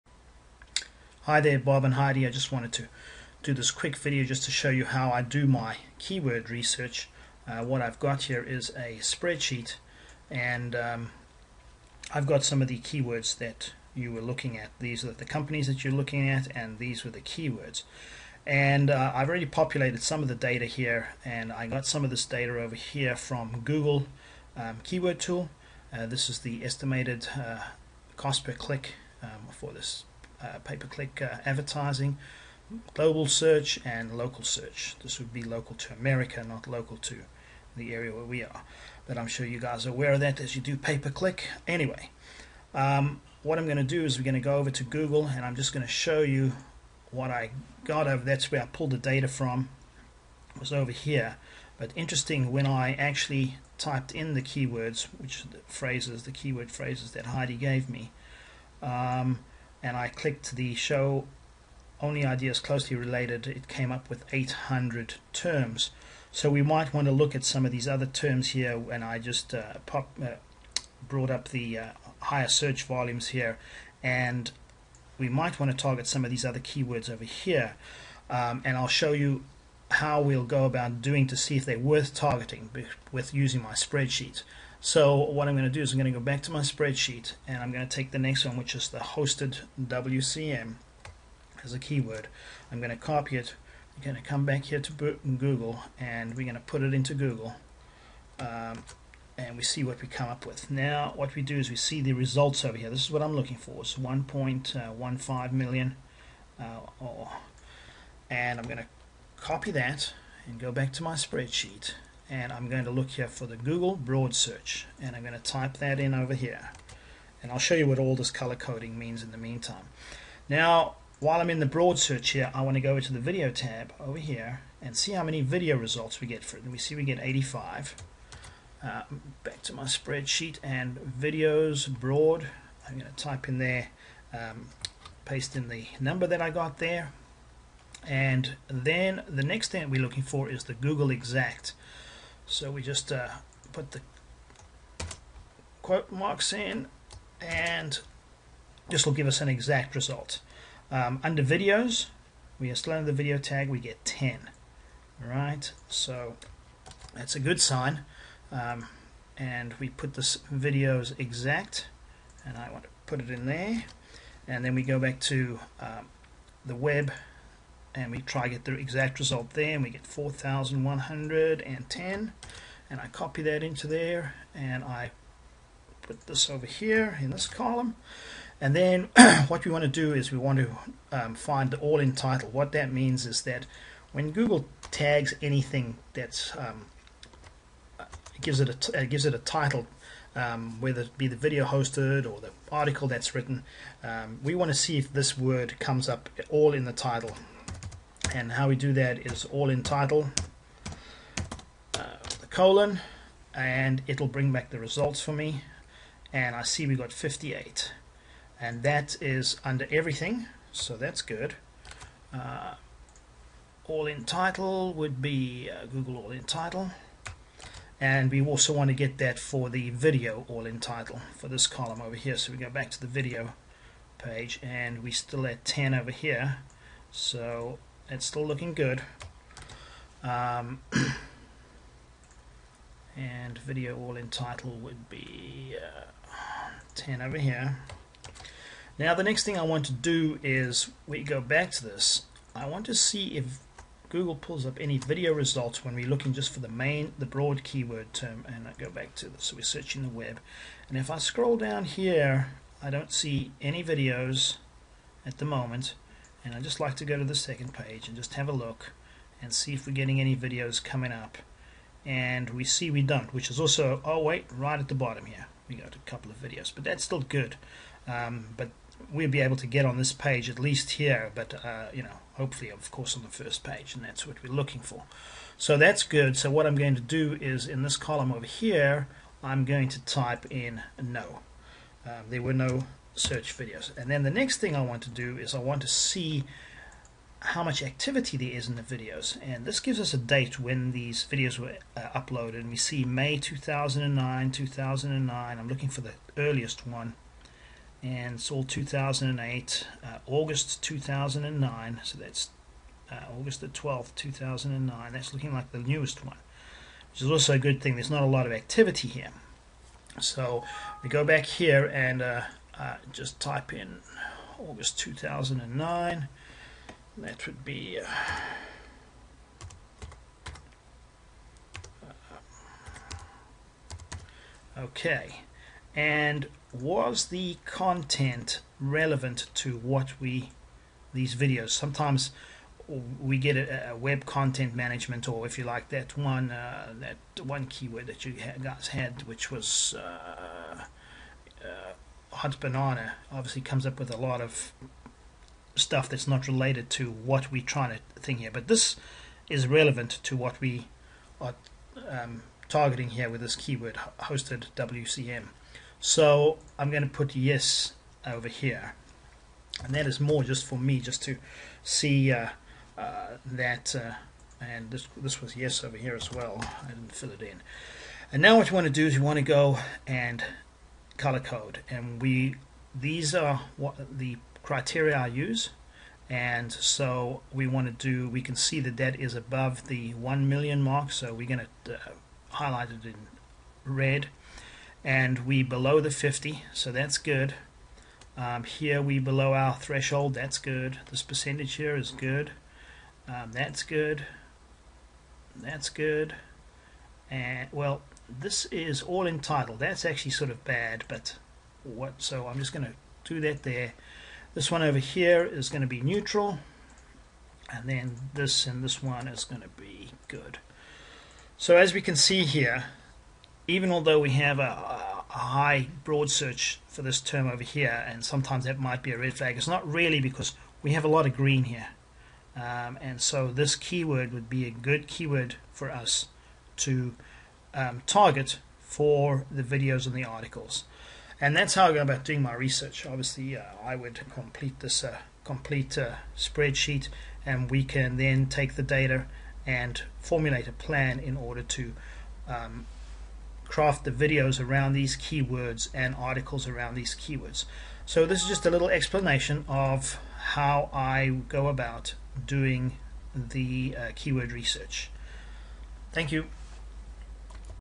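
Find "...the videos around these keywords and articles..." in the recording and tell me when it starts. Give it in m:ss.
7:24.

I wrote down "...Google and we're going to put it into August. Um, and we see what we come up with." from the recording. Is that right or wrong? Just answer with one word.
wrong.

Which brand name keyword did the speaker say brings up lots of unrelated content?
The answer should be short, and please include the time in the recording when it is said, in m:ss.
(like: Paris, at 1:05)
Hunts Banana, at 5:42.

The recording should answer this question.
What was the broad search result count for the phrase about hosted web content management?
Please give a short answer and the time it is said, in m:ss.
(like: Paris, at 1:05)
1.15 million, at 1:43.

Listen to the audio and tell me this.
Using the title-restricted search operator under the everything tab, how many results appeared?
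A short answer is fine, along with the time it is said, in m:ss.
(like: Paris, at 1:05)
58, at 3:27.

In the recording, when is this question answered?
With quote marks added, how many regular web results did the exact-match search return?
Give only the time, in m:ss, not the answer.
2:50.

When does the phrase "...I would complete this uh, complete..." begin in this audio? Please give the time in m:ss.
7:13.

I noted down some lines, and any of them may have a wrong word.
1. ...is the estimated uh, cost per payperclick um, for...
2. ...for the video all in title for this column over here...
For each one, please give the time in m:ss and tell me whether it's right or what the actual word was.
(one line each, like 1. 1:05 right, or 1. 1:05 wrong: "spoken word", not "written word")
1. 0:26 wrong: "click", not "payperclick"
2. 3:39 right.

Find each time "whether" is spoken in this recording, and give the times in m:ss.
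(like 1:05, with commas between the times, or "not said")
3:10.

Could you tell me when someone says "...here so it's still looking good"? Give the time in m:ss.
3:46.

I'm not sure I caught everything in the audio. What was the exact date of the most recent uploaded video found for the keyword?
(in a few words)
August 12, 2009.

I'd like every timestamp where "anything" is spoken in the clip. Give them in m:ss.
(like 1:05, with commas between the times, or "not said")
3:05.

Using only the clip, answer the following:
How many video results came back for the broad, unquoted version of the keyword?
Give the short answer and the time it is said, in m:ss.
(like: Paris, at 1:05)
85, at 2:07.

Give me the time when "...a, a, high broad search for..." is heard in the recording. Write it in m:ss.
6:54.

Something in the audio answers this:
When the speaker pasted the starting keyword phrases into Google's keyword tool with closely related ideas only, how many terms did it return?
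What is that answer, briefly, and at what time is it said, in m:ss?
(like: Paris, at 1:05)
800, at 1:04.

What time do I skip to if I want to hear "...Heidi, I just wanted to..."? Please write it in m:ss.
0:01.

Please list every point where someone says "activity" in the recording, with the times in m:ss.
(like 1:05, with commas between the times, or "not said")
4:47, 5:08.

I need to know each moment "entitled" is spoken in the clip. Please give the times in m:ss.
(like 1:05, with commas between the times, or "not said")
6:39.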